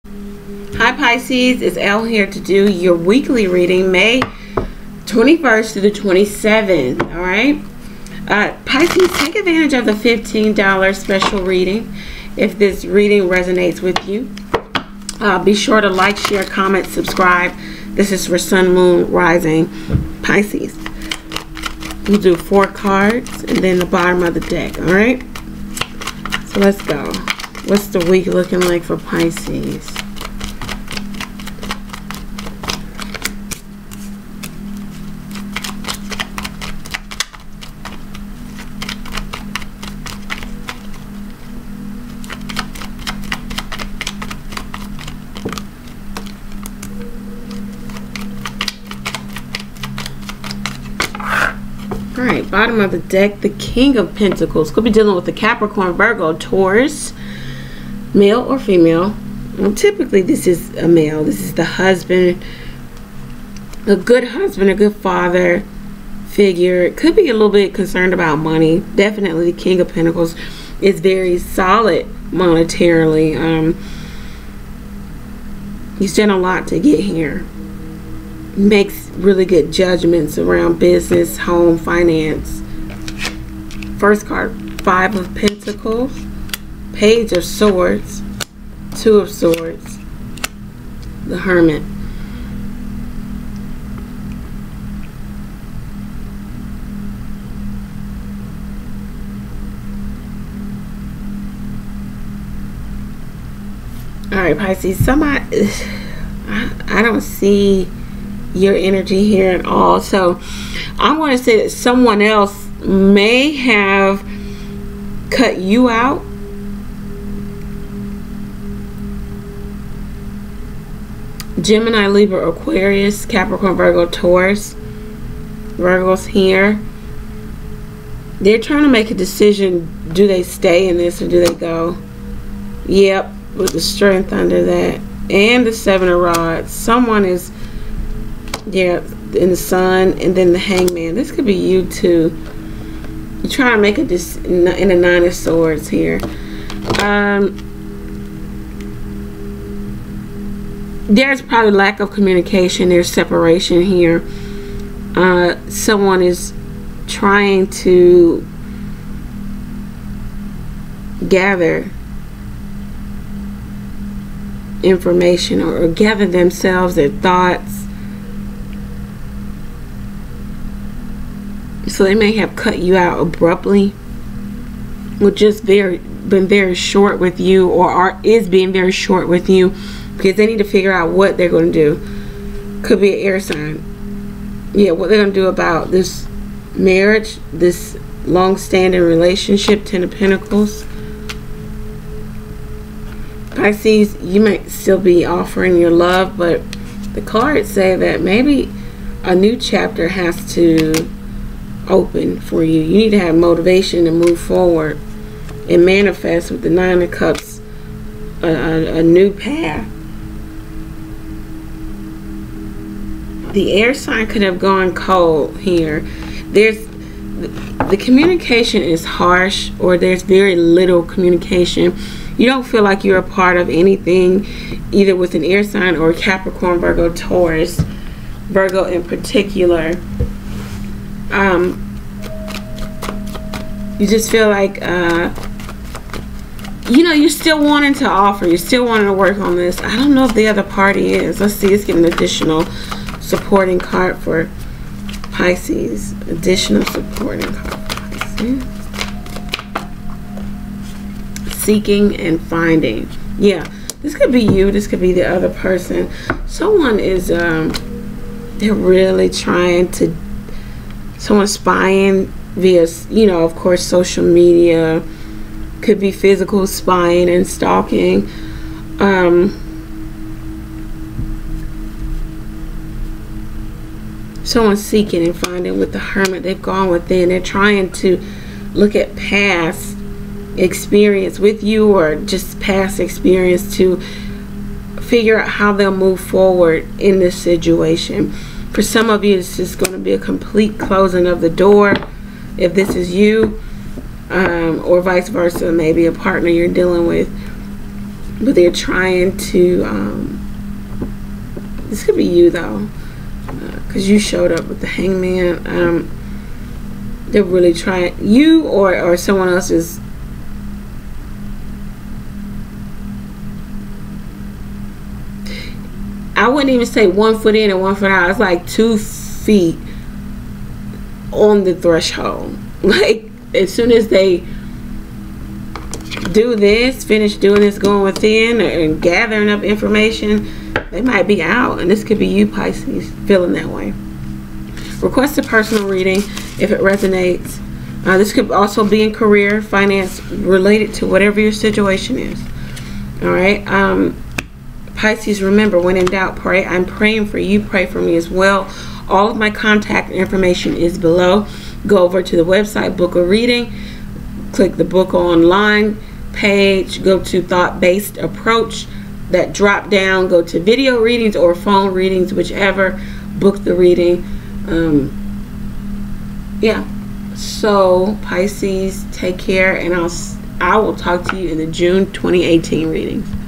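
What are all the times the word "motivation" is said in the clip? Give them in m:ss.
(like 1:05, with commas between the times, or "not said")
3:23.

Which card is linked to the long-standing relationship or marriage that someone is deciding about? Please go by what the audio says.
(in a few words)
Ten of Pentacles.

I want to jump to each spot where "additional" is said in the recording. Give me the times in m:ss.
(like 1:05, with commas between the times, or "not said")
4:02, 4:06.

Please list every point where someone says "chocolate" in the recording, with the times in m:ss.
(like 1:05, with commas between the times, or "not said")
not said.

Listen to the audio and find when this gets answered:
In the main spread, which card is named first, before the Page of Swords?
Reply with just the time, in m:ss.
1:24.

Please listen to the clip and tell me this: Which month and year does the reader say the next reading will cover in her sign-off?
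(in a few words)
June 2018.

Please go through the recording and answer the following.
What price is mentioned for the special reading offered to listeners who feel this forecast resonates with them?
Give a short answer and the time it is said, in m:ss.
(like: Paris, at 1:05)
$15, at 0:09.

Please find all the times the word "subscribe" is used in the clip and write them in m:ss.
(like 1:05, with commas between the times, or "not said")
0:16.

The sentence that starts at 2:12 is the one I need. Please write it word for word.
Yep, with the strength under that.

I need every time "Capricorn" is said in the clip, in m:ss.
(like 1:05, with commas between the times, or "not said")
0:55, 2:03, 3:46.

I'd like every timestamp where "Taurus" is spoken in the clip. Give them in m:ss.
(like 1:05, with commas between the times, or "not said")
0:56, 2:04, 3:47.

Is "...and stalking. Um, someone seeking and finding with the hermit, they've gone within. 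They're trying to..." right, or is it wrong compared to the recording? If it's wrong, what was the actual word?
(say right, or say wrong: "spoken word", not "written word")
right.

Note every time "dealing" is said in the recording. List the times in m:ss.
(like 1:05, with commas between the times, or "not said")
0:54, 4:56.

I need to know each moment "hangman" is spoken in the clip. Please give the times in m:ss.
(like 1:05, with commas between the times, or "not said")
2:20, 5:04.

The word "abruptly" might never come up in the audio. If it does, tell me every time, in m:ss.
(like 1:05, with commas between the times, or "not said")
2:53.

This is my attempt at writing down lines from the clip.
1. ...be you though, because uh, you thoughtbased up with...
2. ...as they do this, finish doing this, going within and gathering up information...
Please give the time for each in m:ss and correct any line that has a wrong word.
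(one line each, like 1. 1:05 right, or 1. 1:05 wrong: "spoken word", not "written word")
1. 5:02 wrong: "showed", not "thoughtbased"
2. 5:23 right.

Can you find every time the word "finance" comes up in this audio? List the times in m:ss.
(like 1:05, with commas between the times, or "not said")
1:21, 5:39.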